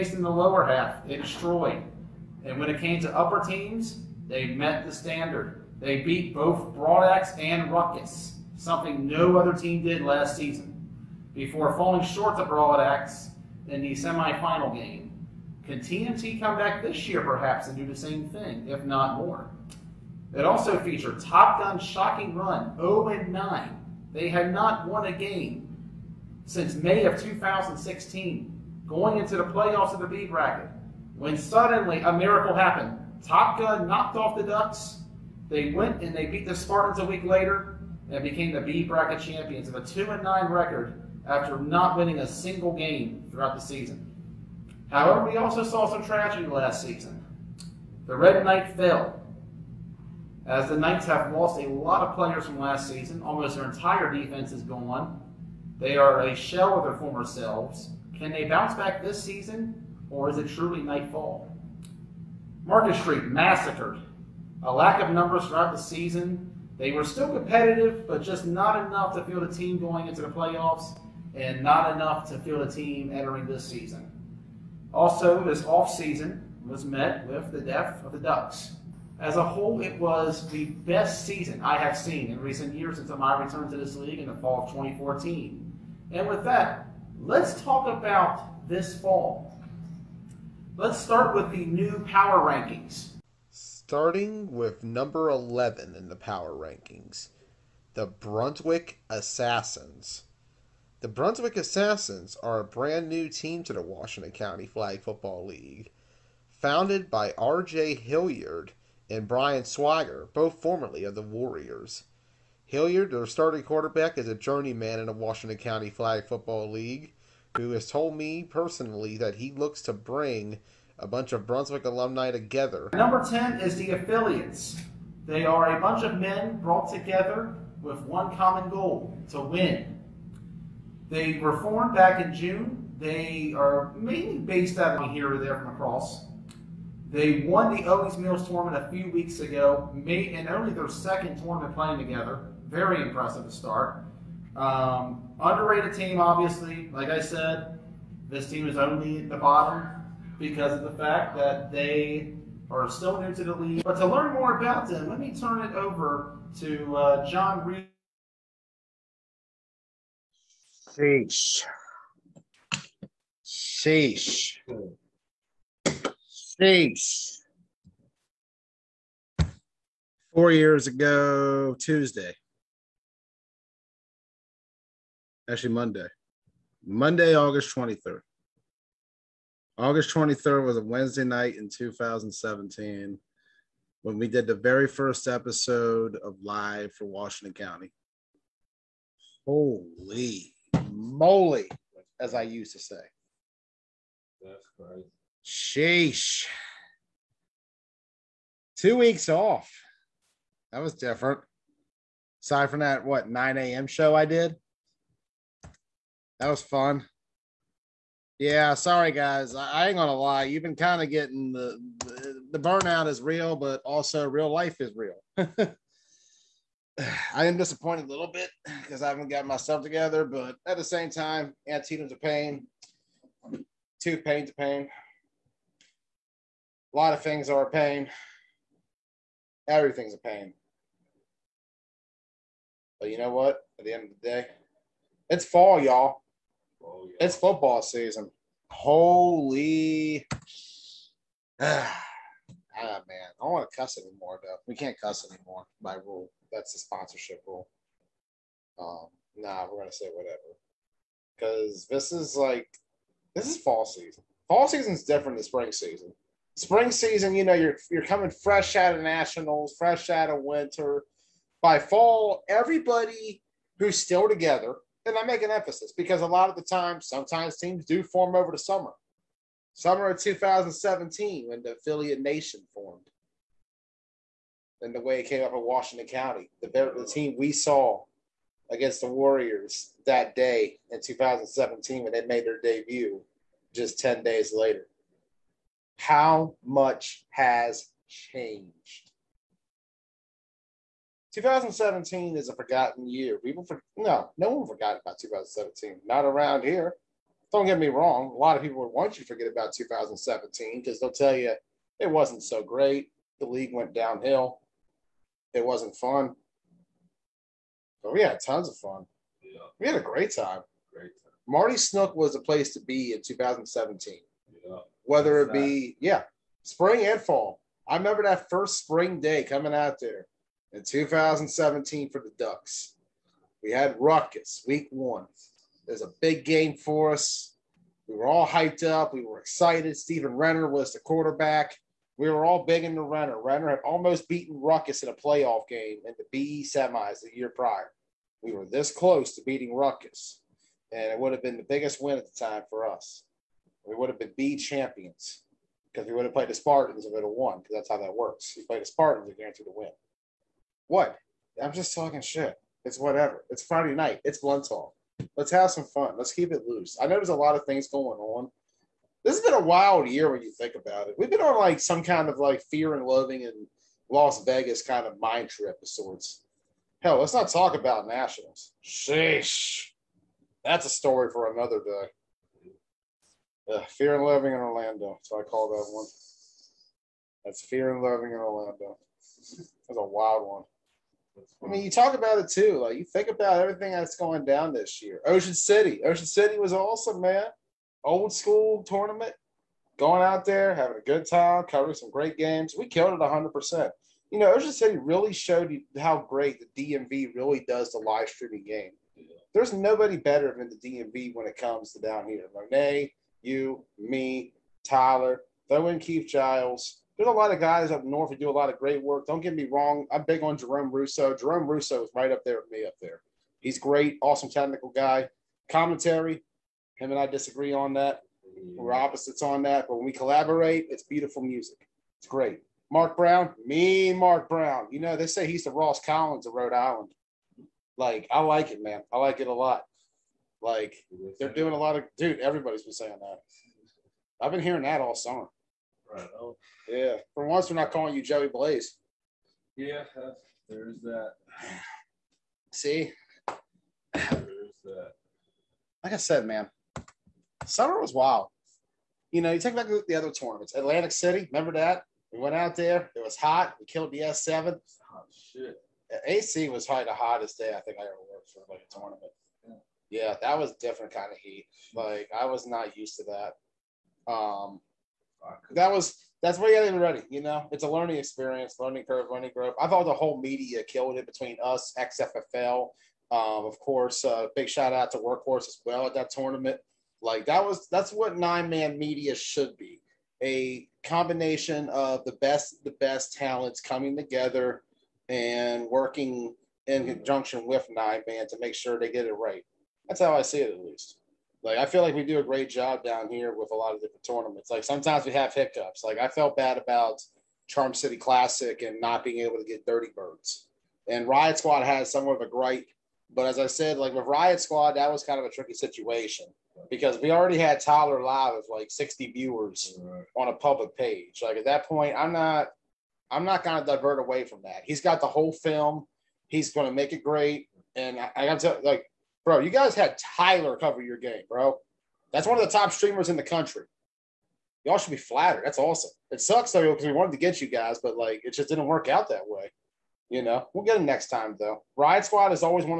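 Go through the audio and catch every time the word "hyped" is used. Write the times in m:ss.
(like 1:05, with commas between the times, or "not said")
5:28.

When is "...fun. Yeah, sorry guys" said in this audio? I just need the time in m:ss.
3:26.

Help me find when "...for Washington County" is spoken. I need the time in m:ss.
3:06.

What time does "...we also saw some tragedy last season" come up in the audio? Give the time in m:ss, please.
0:45.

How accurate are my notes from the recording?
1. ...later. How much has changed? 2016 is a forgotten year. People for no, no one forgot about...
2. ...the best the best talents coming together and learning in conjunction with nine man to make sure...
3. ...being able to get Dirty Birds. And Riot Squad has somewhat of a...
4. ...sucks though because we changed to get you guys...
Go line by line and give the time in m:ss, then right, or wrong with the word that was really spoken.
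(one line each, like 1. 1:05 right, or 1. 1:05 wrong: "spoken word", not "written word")
1. 4:44 wrong: "2017", not "2016"
2. 8:02 wrong: "working", not "learning"
3. 8:19 right
4. 8:46 wrong: "wanted", not "changed".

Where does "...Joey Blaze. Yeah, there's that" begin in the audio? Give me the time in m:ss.
7:18.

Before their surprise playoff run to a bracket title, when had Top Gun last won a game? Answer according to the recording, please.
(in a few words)
May 2016.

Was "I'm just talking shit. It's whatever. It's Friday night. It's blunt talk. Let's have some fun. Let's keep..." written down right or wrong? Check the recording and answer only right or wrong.
right.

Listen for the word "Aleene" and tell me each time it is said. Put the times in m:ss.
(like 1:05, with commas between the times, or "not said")
not said.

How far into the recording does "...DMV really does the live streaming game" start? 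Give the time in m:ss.
6:36.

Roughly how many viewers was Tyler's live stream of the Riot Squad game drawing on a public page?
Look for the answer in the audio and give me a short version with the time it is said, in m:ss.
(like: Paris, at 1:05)
60, at 8:28.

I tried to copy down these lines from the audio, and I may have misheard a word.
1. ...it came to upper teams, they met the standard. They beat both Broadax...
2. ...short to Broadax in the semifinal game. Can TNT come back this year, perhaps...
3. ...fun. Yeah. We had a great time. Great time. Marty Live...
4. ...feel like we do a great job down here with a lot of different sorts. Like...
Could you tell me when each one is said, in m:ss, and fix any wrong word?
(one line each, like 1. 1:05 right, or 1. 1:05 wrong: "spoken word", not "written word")
1. 0:02 right
2. 0:12 right
3. 5:08 wrong: "Snook", not "Live"
4. 8:11 wrong: "tournaments", not "sorts".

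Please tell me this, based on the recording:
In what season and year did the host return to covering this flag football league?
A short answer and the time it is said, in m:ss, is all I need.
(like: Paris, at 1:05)
Fall 2014, at 1:24.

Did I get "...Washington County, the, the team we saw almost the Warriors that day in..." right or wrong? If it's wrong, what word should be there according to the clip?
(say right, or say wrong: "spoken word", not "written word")
wrong: "against", not "almost".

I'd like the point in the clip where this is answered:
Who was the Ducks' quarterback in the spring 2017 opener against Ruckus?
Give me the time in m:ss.
5:29.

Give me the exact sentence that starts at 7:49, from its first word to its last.
I thought the whole media killed it between us, XFFL, um, of course.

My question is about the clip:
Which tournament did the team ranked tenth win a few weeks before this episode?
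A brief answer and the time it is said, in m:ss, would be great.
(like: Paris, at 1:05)
Owings Mills, at 2:17.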